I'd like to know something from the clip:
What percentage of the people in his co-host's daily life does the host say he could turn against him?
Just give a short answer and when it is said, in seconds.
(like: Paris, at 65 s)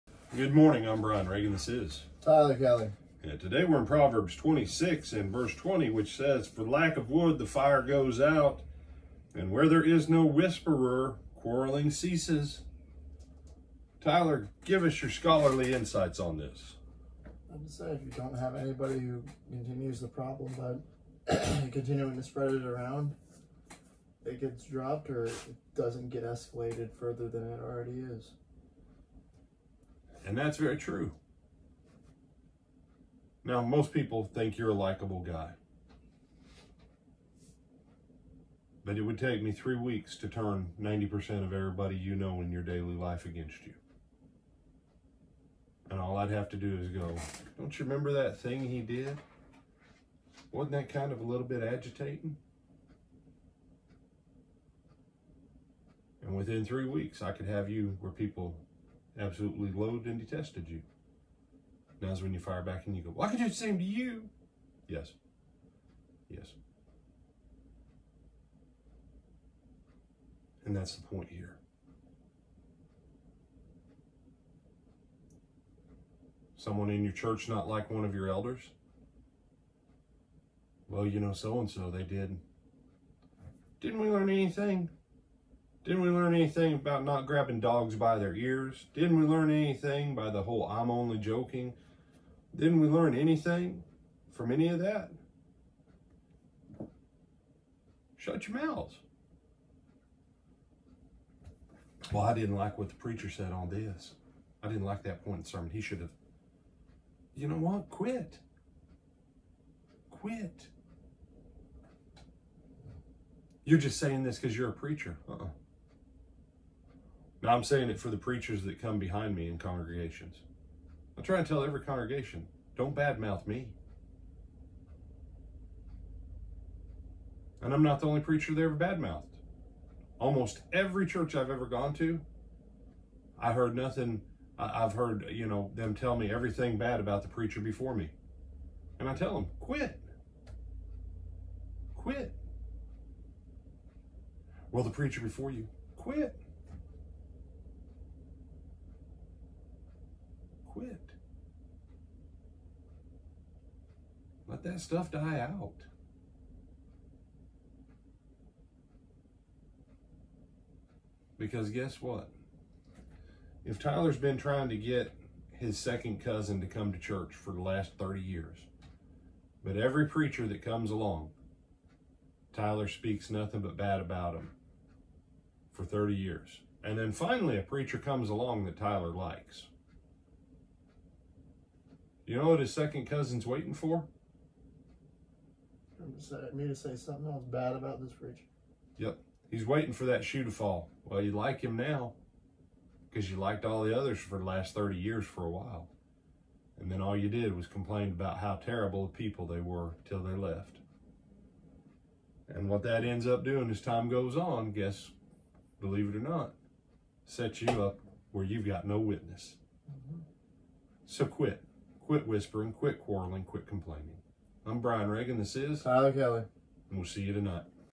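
90%, at 40 s.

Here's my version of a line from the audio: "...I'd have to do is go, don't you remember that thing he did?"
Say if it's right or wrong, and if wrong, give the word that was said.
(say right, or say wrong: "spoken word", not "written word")
right.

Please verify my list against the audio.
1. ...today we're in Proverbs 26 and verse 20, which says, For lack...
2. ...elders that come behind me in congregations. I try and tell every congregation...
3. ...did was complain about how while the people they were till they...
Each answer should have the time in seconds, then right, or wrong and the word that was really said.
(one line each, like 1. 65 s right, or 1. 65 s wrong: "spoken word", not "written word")
1. 3 s right
2. 118 s wrong: "preachers", not "elders"
3. 197 s wrong: "terrible", not "while".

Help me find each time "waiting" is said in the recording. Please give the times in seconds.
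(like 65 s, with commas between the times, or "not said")
183 s, 189 s.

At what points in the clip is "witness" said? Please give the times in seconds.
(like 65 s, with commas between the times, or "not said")
208 s.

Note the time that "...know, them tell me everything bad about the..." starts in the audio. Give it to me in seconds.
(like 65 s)
135 s.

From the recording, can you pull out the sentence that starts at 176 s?
And then finally, a preacher comes along that Tyler likes.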